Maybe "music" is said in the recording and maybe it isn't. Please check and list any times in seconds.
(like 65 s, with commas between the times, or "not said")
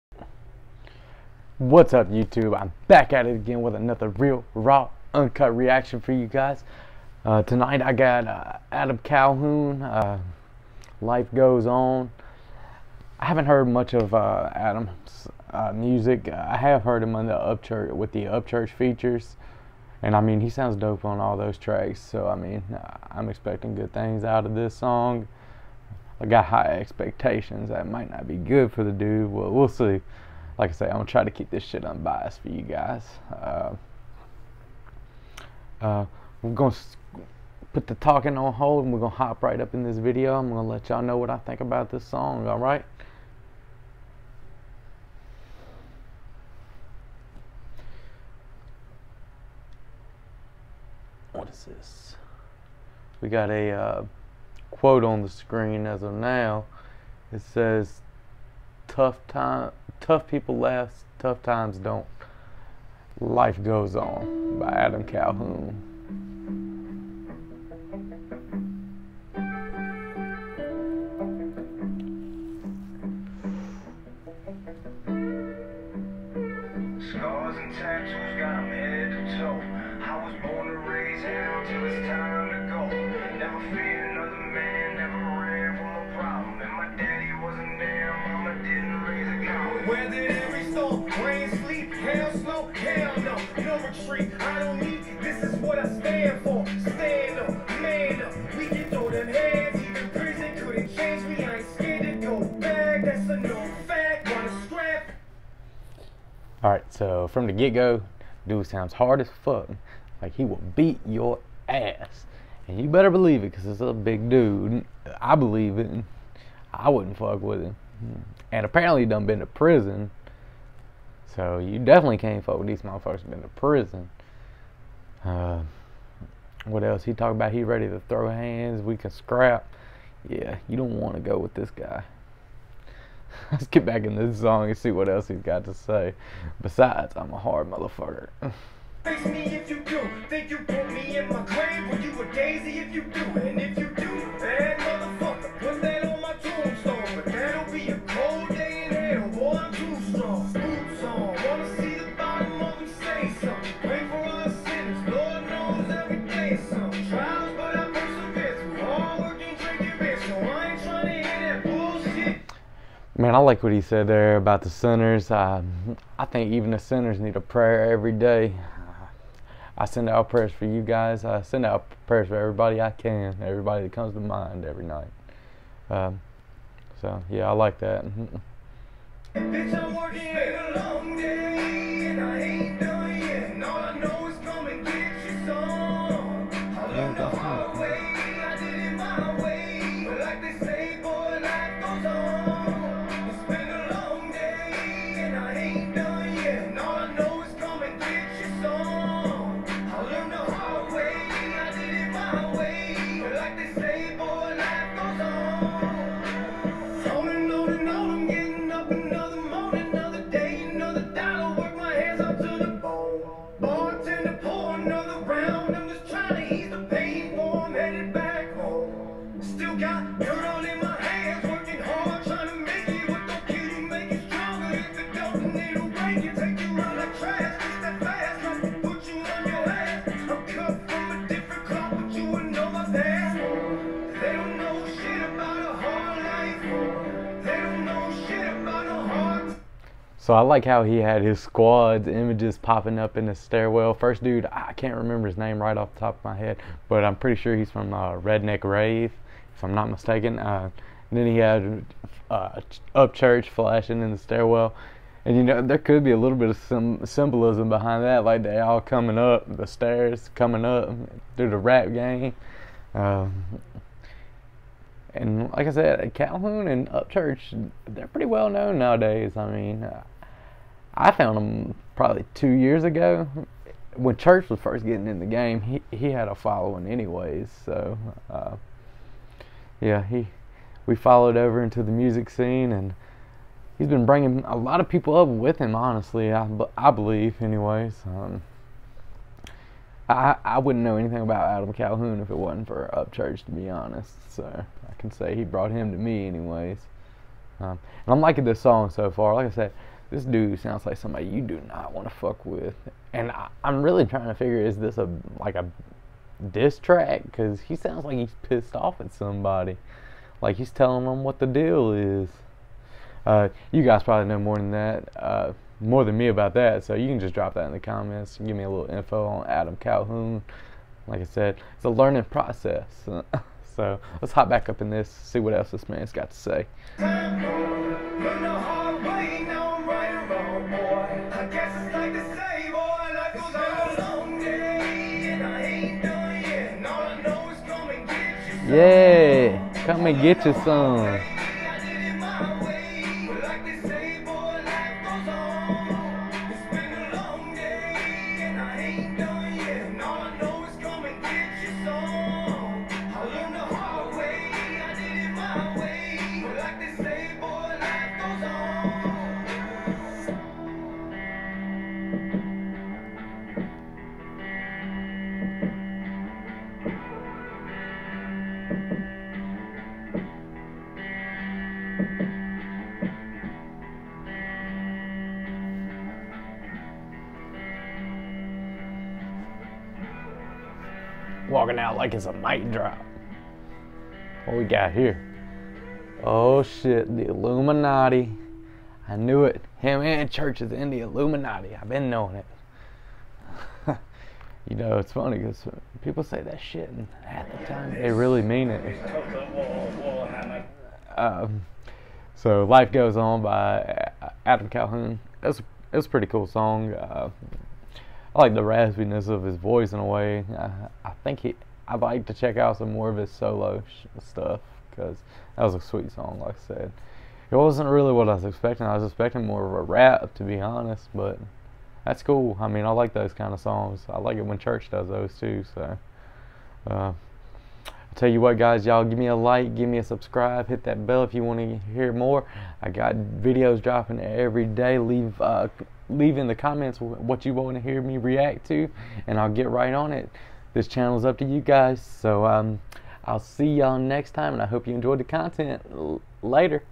15 s, 281 s.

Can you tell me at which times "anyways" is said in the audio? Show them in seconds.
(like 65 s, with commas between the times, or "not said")
276 s, 287 s, 296 s.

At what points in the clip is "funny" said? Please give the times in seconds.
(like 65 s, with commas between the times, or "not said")
395 s.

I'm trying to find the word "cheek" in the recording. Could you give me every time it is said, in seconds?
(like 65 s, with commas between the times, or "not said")
not said.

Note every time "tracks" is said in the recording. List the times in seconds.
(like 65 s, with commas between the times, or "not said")
21 s, 306 s.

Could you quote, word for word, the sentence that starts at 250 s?
Uh, then he had uh, Upchurch flashing in the stairwell.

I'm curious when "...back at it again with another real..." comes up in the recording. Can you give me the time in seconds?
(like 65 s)
2 s.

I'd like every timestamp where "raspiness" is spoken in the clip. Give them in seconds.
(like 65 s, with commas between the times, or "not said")
408 s.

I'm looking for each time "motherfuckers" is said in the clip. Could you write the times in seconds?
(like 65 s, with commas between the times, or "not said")
122 s, 137 s.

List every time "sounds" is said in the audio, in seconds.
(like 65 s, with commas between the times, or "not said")
20 s, 108 s, 300 s, 307 s.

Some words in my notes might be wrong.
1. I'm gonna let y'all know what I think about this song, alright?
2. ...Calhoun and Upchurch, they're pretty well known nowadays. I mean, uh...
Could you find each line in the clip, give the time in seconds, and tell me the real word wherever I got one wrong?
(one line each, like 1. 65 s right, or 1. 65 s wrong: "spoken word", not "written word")
1. 40 s right
2. 266 s right.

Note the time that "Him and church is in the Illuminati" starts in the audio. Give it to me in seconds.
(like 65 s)
389 s.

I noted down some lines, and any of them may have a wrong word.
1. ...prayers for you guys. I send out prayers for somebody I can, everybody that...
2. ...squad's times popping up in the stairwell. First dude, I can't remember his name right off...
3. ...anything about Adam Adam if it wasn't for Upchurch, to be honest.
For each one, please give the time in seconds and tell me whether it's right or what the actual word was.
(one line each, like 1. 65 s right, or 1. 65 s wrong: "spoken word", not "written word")
1. 170 s wrong: "everybody", not "somebody"
2. 241 s wrong: "images", not "times"
3. 290 s wrong: "Calhoun", not "Adam".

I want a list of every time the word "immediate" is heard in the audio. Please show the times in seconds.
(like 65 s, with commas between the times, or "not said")
not said.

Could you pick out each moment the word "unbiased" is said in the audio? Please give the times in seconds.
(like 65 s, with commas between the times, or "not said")
31 s.